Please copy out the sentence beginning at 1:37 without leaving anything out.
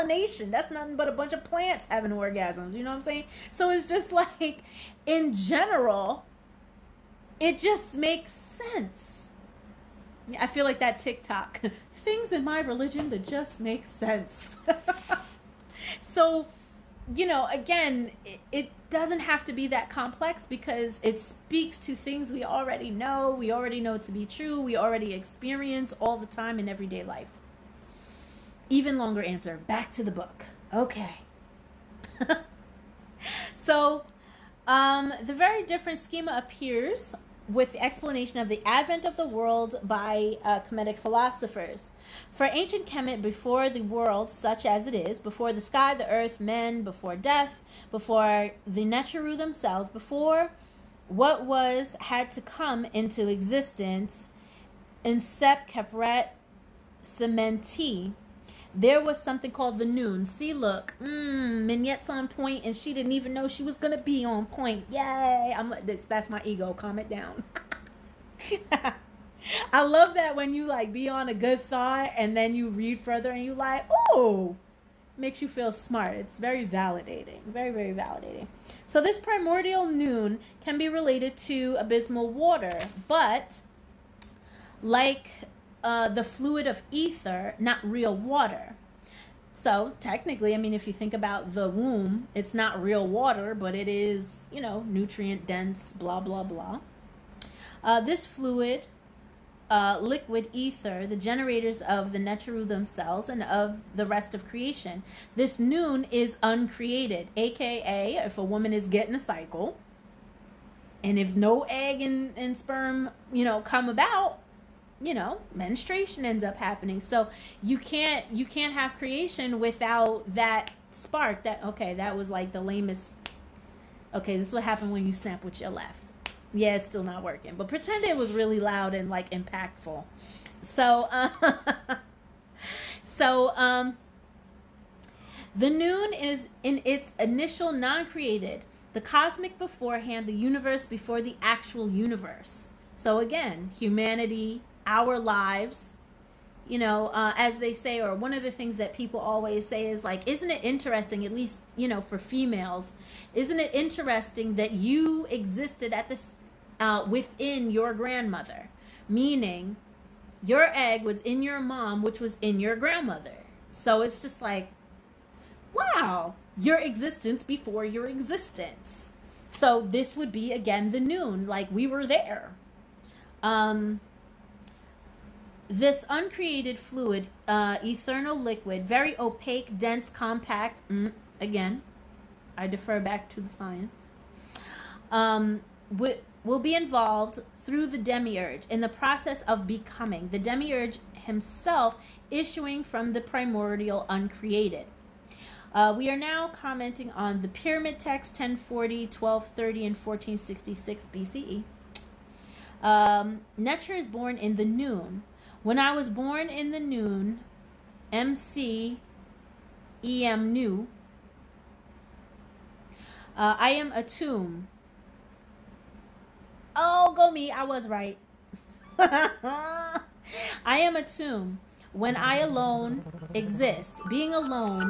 Uh, this fluid, uh, liquid ether, the generators of the Neteru themselves and of the rest of creation.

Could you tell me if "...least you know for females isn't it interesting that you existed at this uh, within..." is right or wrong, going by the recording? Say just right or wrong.
right.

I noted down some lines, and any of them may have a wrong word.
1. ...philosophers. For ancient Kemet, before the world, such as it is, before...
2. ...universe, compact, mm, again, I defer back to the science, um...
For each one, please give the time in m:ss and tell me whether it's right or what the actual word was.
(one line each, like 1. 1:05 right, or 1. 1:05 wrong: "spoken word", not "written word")
1. 0:40 right
2. 2:59 wrong: "dense", not "universe".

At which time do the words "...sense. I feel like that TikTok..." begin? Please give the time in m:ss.
0:08.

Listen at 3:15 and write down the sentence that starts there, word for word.
Uh, we are now commenting on the pyramid text 1040, 1230, and 1466 BCE.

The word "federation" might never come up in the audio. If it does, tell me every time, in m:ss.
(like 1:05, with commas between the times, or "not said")
not said.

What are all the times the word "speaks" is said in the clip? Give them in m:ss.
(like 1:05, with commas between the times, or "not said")
0:21.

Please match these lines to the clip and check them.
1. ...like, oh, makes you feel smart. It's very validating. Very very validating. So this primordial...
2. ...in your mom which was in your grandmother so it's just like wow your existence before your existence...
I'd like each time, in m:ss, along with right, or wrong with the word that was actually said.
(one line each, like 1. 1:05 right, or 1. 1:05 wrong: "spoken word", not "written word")
1. 1:13 right
2. 2:41 right.